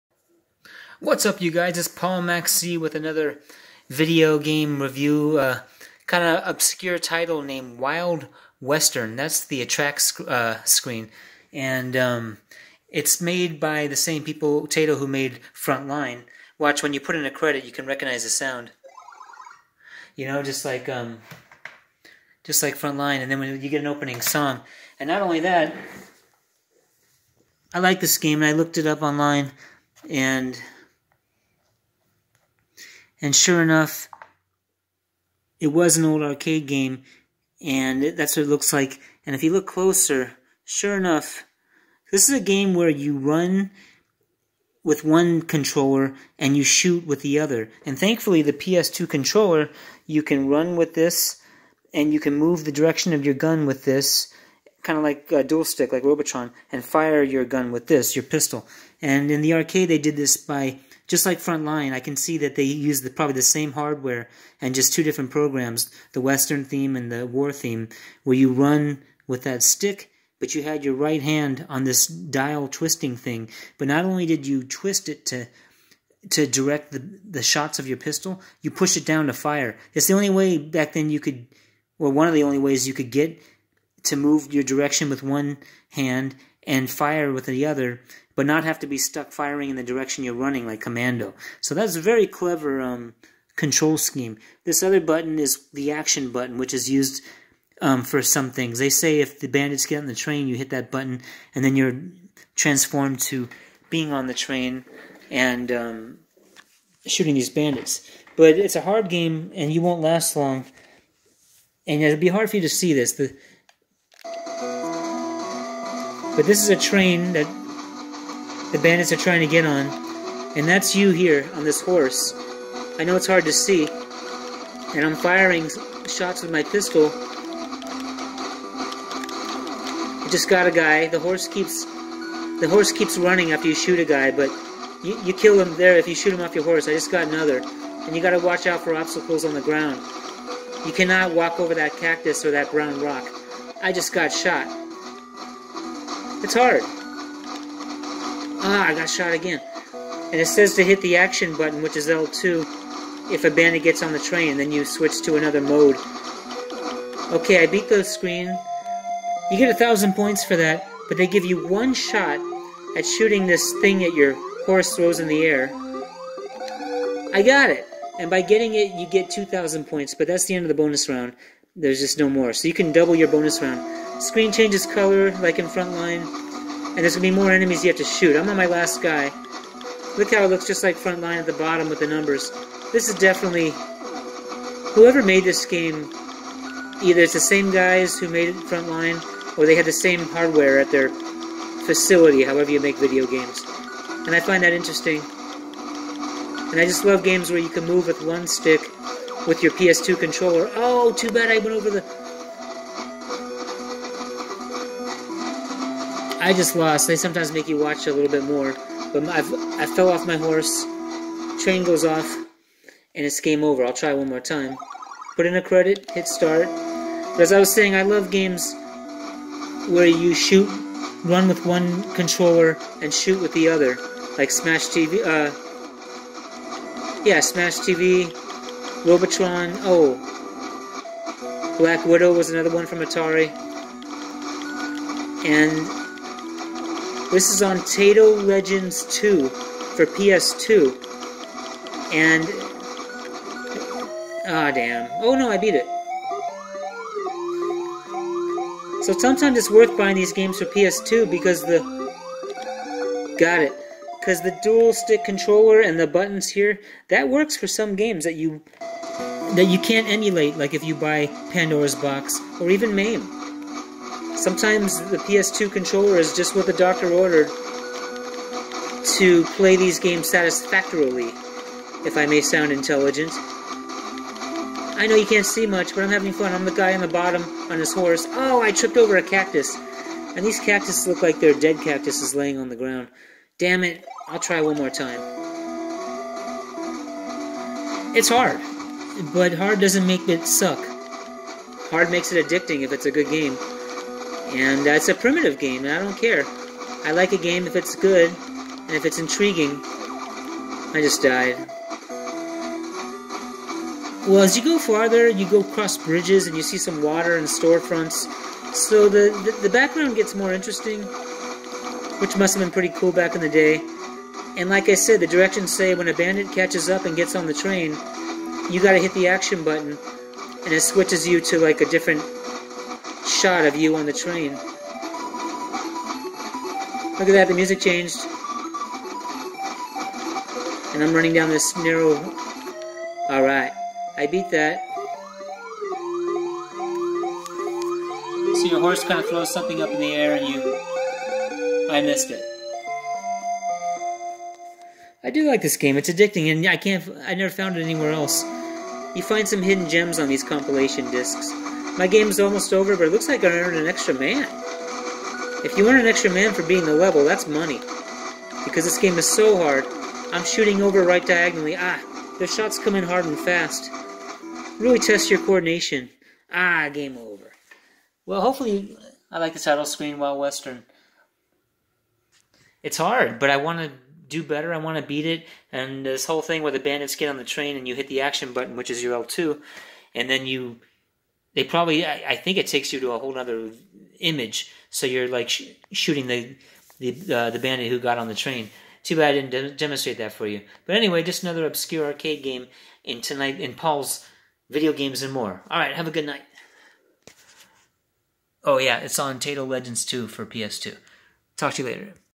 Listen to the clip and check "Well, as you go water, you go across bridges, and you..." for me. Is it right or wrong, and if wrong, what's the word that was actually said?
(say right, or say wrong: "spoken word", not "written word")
wrong: "farther", not "water".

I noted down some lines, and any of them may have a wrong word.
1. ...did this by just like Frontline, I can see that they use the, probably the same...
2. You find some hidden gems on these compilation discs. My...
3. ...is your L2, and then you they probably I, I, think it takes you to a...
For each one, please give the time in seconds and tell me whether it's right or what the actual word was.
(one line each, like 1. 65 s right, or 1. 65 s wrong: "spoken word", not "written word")
1. 59 s right
2. 349 s right
3. 378 s right.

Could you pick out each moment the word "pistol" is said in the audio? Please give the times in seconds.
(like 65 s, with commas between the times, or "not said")
58 s, 77 s, 126 s.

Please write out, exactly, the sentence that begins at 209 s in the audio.
But I've, I fell off my horse.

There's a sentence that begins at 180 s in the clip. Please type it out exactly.
Look how it looks just like Frontline at the bottom with the numbers.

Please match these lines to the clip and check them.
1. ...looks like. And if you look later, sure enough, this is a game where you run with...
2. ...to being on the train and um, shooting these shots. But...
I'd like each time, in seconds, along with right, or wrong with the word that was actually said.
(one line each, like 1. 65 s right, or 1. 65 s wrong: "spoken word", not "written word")
1. 38 s wrong: "closer", not "later"
2. 103 s wrong: "bandits", not "shots".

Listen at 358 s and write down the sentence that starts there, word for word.
Because this game is so hard, I'm shooting over right diagonally.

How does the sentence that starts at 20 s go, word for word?
You know, just like um, just like Frontline, and then when you get an opening song, and not only that.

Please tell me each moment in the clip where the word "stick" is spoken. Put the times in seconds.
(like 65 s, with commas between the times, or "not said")
55 s, 69 s, 198 s, 254 s.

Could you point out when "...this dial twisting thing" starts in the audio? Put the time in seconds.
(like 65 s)
71 s.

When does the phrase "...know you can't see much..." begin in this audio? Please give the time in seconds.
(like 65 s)
275 s.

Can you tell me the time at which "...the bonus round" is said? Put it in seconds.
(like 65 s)
170 s.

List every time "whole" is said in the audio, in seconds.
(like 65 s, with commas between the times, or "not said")
376 s, 383 s.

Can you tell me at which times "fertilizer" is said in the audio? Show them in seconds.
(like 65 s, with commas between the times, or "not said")
not said.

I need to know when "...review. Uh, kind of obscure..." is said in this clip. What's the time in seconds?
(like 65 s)
4 s.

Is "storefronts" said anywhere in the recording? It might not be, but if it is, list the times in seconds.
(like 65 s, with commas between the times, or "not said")
307 s.